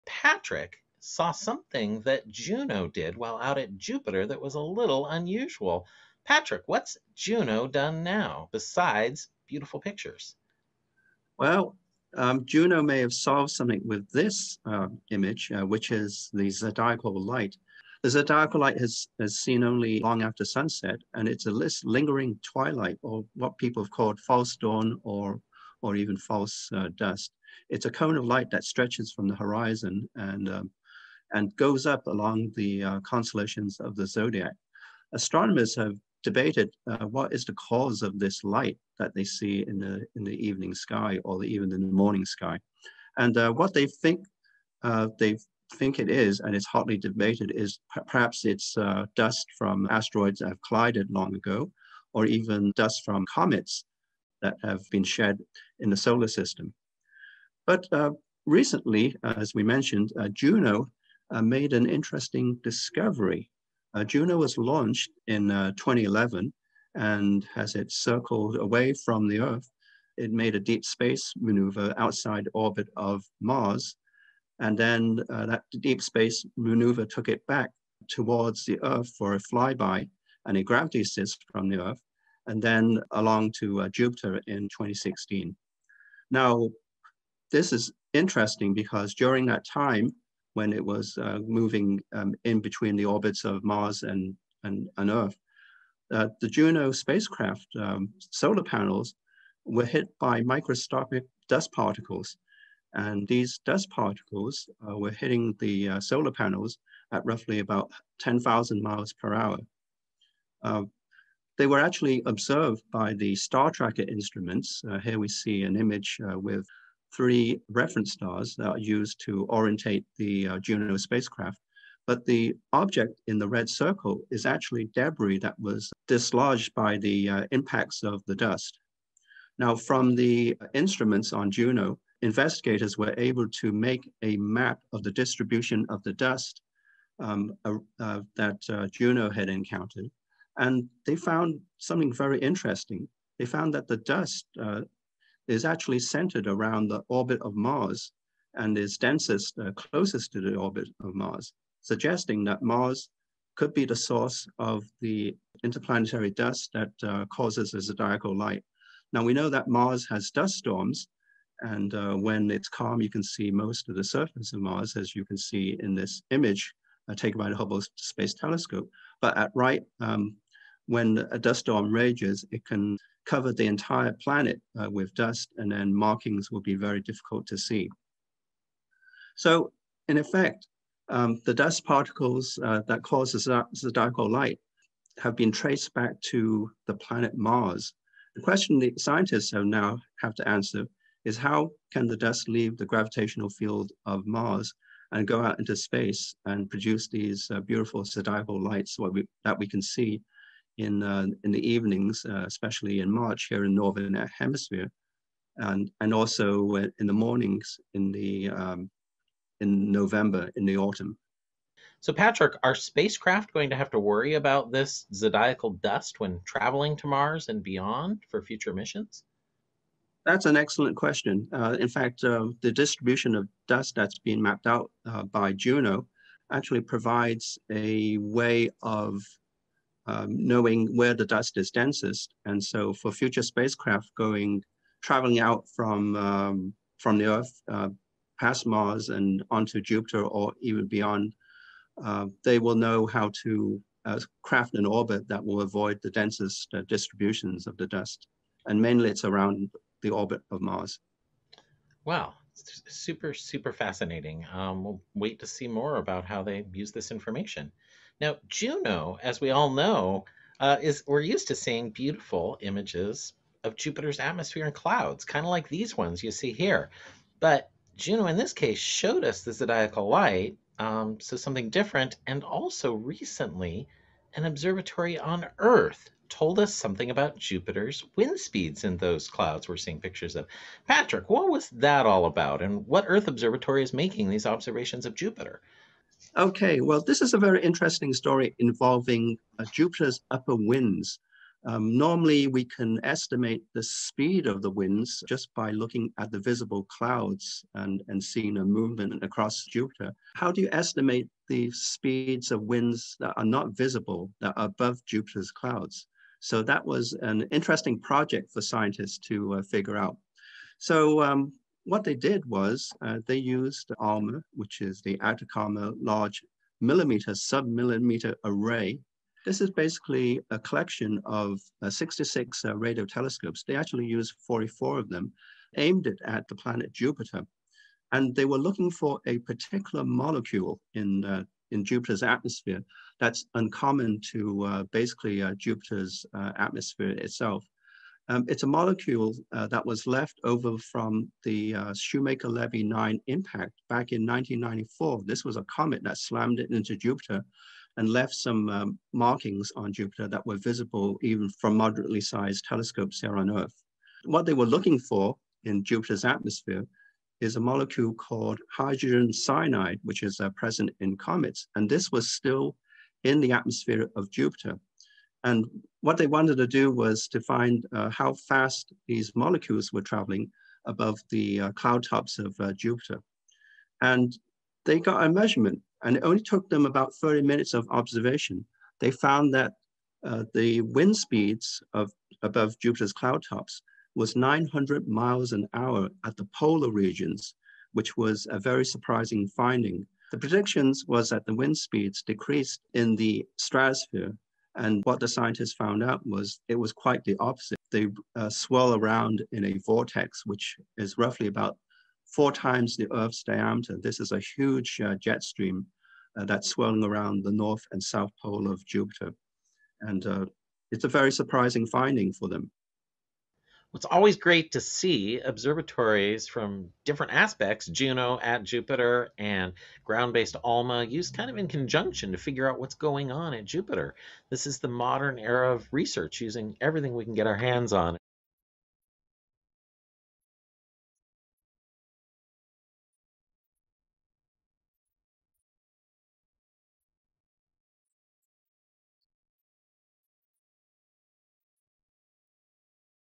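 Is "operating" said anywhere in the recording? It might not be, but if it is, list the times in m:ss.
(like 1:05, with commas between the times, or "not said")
not said.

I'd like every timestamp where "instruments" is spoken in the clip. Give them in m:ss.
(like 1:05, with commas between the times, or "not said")
1:54, 2:10.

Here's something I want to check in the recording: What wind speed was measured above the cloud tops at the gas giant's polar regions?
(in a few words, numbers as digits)
900 miles an hour.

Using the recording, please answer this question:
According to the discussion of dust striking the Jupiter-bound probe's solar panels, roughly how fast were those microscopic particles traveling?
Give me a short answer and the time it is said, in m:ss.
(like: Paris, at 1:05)
10,000 miles per hour, at 1:48.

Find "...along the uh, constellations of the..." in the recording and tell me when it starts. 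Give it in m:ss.
0:32.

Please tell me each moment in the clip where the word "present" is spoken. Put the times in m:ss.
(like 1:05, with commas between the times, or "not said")
6:00.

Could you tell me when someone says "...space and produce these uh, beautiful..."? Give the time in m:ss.
3:15.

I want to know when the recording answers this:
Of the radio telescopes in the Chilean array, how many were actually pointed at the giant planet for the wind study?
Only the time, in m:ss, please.
5:24.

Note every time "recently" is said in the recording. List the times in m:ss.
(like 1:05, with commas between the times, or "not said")
0:58, 4:32.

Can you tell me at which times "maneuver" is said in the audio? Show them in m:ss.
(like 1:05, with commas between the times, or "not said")
1:11, 1:16.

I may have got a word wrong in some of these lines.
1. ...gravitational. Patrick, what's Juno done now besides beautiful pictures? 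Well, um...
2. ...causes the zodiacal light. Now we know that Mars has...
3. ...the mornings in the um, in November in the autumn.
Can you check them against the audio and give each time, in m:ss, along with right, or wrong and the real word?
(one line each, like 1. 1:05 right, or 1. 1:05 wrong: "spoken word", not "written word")
1. 0:05 wrong: "unusual", not "gravitational"
2. 2:37 right
3. 3:27 right.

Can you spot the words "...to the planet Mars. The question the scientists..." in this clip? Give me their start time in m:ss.
3:06.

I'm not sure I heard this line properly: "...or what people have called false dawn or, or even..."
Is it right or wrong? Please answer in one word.
right.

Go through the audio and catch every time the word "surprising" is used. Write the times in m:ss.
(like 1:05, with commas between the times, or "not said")
6:28, 6:51.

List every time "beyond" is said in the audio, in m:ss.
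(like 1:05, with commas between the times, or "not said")
3:37, 4:00.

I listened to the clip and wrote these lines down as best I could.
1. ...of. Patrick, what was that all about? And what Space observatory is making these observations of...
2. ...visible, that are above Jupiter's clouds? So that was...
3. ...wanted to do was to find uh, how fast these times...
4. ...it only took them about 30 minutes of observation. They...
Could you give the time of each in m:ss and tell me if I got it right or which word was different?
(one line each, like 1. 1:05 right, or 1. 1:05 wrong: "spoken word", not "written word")
1. 4:40 wrong: "Earth", not "Space"
2. 5:03 right
3. 6:06 wrong: "molecules", not "times"
4. 6:16 right.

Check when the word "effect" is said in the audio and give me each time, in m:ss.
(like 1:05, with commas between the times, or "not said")
3:00.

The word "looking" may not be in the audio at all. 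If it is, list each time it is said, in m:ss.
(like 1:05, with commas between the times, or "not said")
4:55, 5:28, 5:54.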